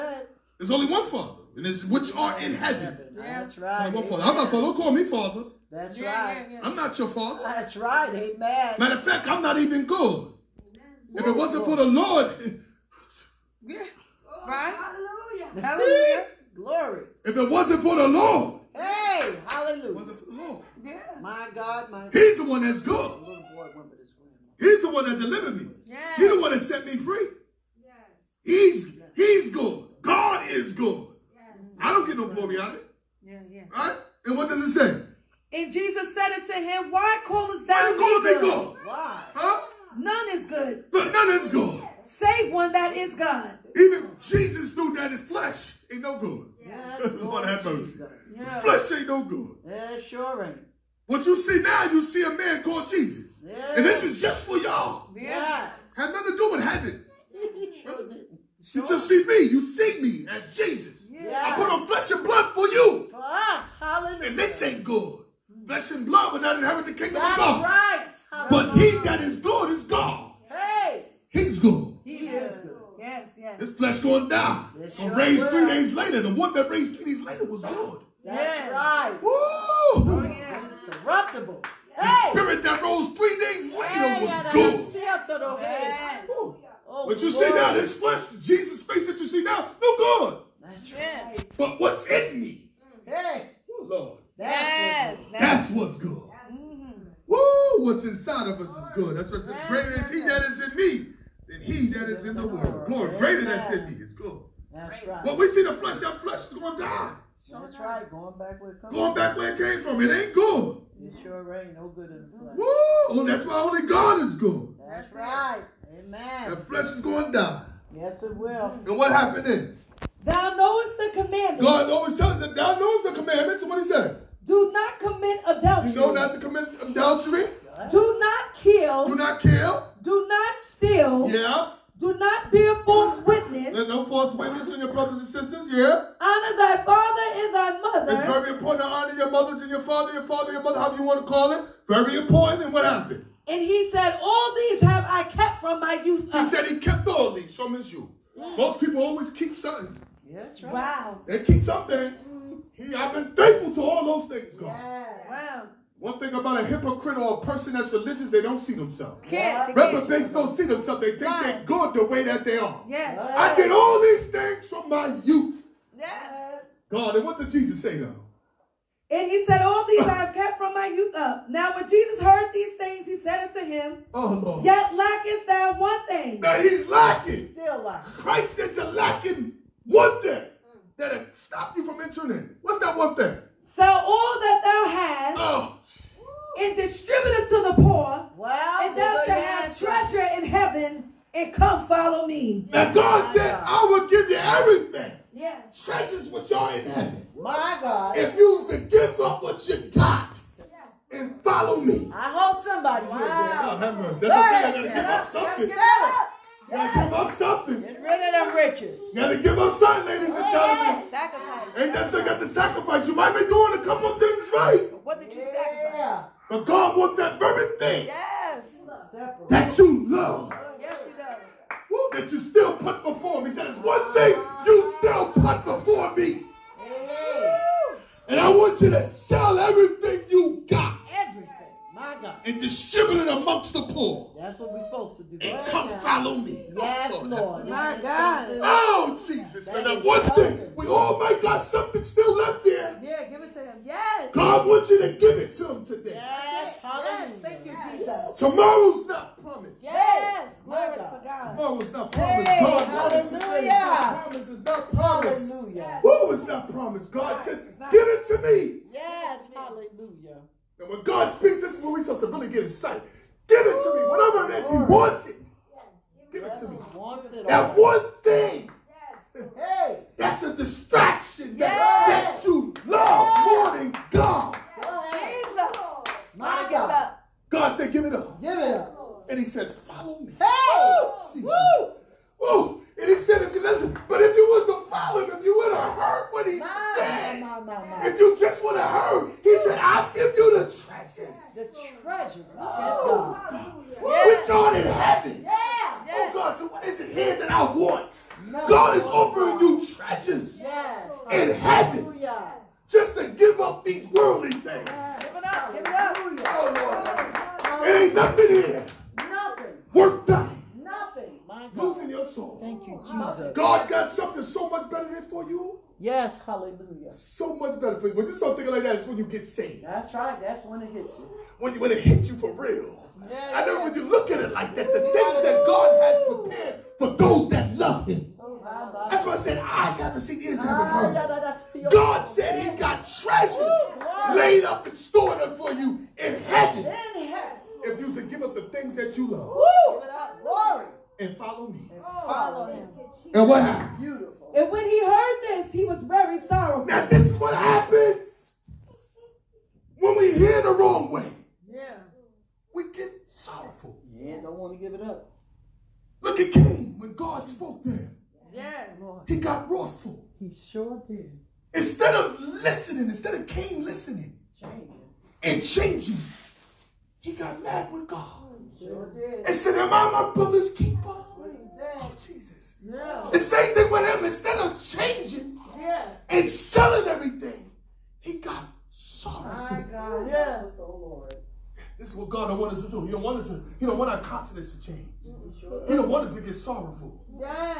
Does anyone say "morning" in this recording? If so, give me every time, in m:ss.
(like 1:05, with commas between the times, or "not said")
4:33.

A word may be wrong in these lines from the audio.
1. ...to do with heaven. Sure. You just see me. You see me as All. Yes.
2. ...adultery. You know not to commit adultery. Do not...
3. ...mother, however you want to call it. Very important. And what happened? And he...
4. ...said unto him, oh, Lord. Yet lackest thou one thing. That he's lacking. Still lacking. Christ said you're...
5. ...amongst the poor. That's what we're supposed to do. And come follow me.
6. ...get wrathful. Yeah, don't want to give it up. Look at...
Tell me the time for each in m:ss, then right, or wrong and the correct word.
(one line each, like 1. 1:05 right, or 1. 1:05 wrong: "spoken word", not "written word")
1. 0:56 wrong: "Jesus", not "All"
2. 2:05 right
3. 2:20 right
4. 2:53 right
5. 3:53 right
6. 5:52 wrong: "sorrowful", not "wrathful".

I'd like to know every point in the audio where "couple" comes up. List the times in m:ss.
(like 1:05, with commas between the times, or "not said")
3:33.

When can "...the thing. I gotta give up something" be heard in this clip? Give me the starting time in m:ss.
3:24.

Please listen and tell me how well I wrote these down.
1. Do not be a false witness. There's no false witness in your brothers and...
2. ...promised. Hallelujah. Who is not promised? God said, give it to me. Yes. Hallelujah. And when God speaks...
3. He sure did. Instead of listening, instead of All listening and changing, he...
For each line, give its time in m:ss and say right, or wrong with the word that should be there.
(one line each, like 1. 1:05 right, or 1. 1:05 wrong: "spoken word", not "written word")
1. 2:11 right
2. 4:14 right
3. 6:00 wrong: "Cain", not "All".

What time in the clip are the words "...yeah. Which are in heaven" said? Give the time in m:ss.
4:53.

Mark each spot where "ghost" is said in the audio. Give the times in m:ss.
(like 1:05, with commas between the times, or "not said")
not said.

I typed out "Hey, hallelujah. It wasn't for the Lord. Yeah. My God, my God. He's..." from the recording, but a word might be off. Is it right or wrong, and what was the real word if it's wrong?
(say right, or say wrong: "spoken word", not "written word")
right.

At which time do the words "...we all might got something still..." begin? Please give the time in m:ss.
4:00.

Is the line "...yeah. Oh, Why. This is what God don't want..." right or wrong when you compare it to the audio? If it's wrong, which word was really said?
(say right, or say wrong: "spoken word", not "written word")
wrong: "Lord", not "Why".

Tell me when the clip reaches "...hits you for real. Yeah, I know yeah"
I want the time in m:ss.
5:22.